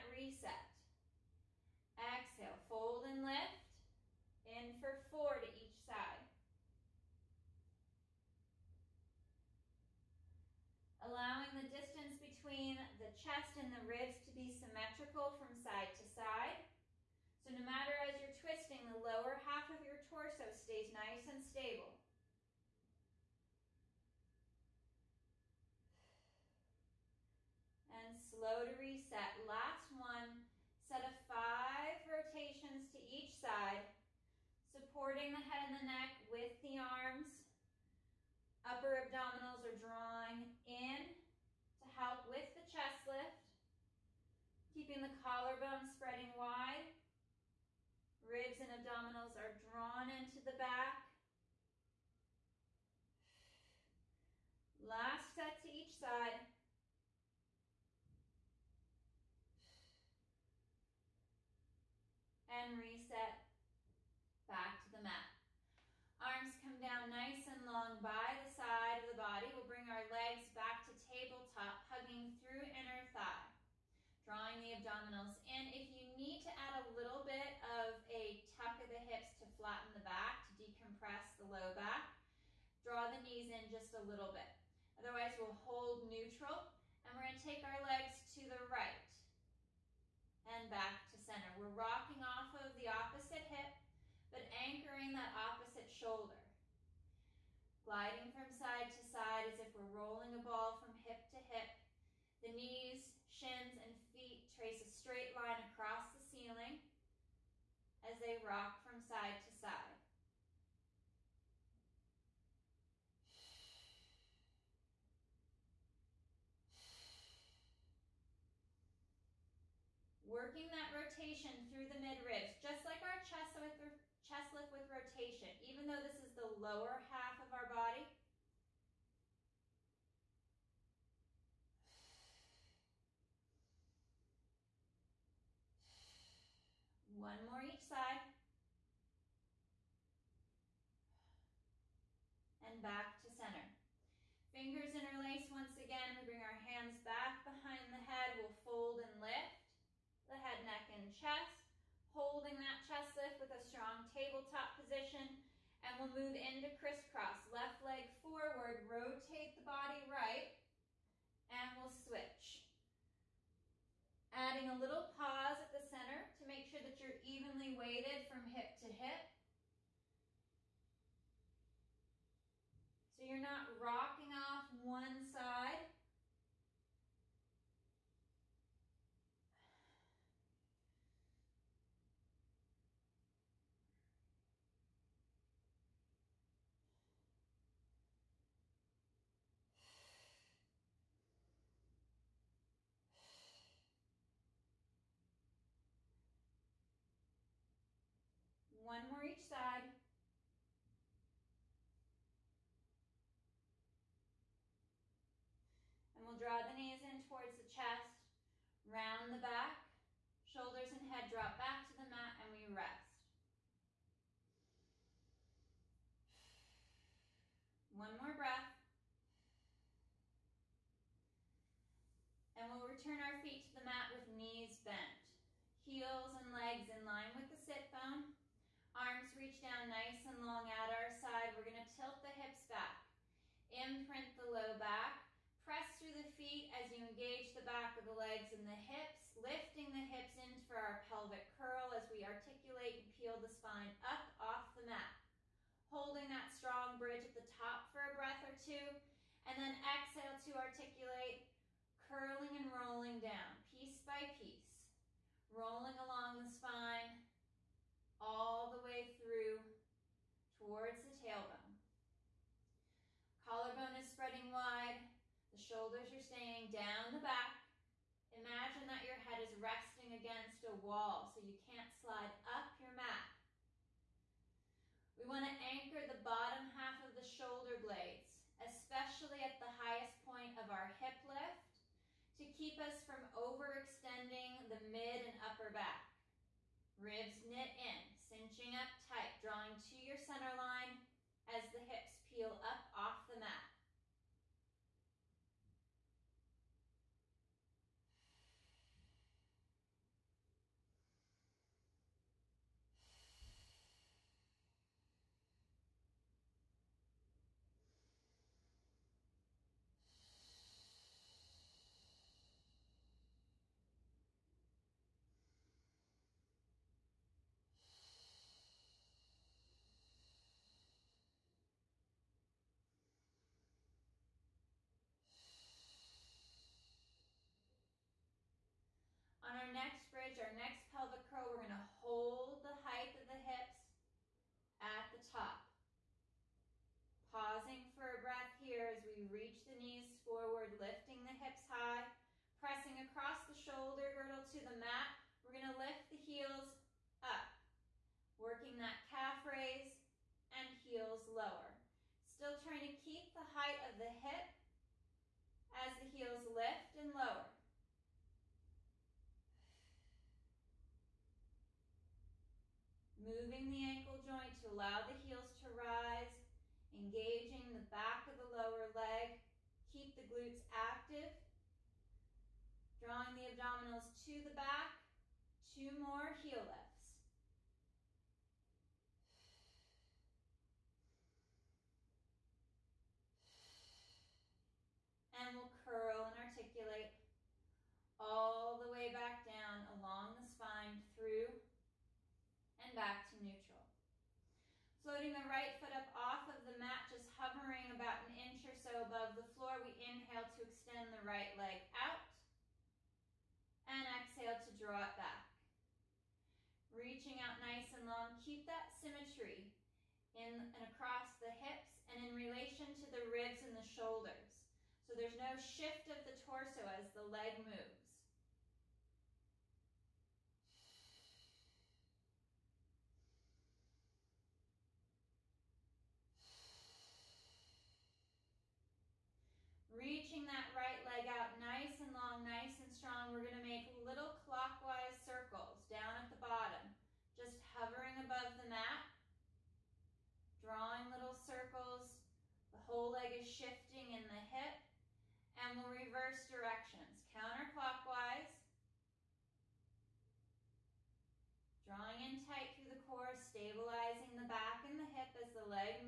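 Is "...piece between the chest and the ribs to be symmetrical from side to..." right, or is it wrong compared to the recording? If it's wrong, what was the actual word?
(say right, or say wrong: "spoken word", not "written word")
wrong: "distance", not "piece".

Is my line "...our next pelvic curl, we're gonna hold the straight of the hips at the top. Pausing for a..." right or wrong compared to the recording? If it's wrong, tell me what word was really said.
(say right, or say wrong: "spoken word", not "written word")
wrong: "height", not "straight".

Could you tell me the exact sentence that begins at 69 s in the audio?
We'll bring our legs back to tabletop, hugging through inner thigh, drawing the abdominals in.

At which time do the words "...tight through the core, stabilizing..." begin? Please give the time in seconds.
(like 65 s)
452 s.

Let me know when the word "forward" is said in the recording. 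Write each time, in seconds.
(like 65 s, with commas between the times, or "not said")
158 s, 340 s.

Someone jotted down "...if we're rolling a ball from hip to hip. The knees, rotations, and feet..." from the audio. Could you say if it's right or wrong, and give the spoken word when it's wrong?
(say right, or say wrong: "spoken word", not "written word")
wrong: "shins", not "rotations".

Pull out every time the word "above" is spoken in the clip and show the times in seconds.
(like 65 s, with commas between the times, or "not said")
399 s, 438 s.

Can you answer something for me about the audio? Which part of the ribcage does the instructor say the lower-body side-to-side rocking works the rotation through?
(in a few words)
Midribs.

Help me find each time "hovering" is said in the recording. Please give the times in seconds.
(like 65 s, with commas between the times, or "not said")
397 s, 437 s.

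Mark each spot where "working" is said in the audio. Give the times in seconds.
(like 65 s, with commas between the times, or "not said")
120 s, 348 s.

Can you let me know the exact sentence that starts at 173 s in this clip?
So you're not rocking off one side.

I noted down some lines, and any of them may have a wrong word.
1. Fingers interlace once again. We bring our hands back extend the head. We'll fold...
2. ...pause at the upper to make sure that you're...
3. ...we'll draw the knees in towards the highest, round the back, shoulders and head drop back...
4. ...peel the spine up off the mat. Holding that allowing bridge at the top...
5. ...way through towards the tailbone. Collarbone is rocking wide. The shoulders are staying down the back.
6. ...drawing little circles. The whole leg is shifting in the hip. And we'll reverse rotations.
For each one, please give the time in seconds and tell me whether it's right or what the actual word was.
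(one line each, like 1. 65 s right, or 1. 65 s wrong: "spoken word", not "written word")
1. 144 s wrong: "behind", not "extend"
2. 165 s wrong: "center", not "upper"
3. 206 s wrong: "chest", not "highest"
4. 243 s wrong: "strong", not "allowing"
5. 258 s wrong: "spreading", not "rocking"
6. 440 s wrong: "directions", not "rotations".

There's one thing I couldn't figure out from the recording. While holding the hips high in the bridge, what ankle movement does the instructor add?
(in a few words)
Calf raise.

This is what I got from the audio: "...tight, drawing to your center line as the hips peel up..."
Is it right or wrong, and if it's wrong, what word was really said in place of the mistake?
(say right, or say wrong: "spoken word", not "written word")
right.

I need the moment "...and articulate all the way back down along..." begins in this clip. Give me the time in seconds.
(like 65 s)
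386 s.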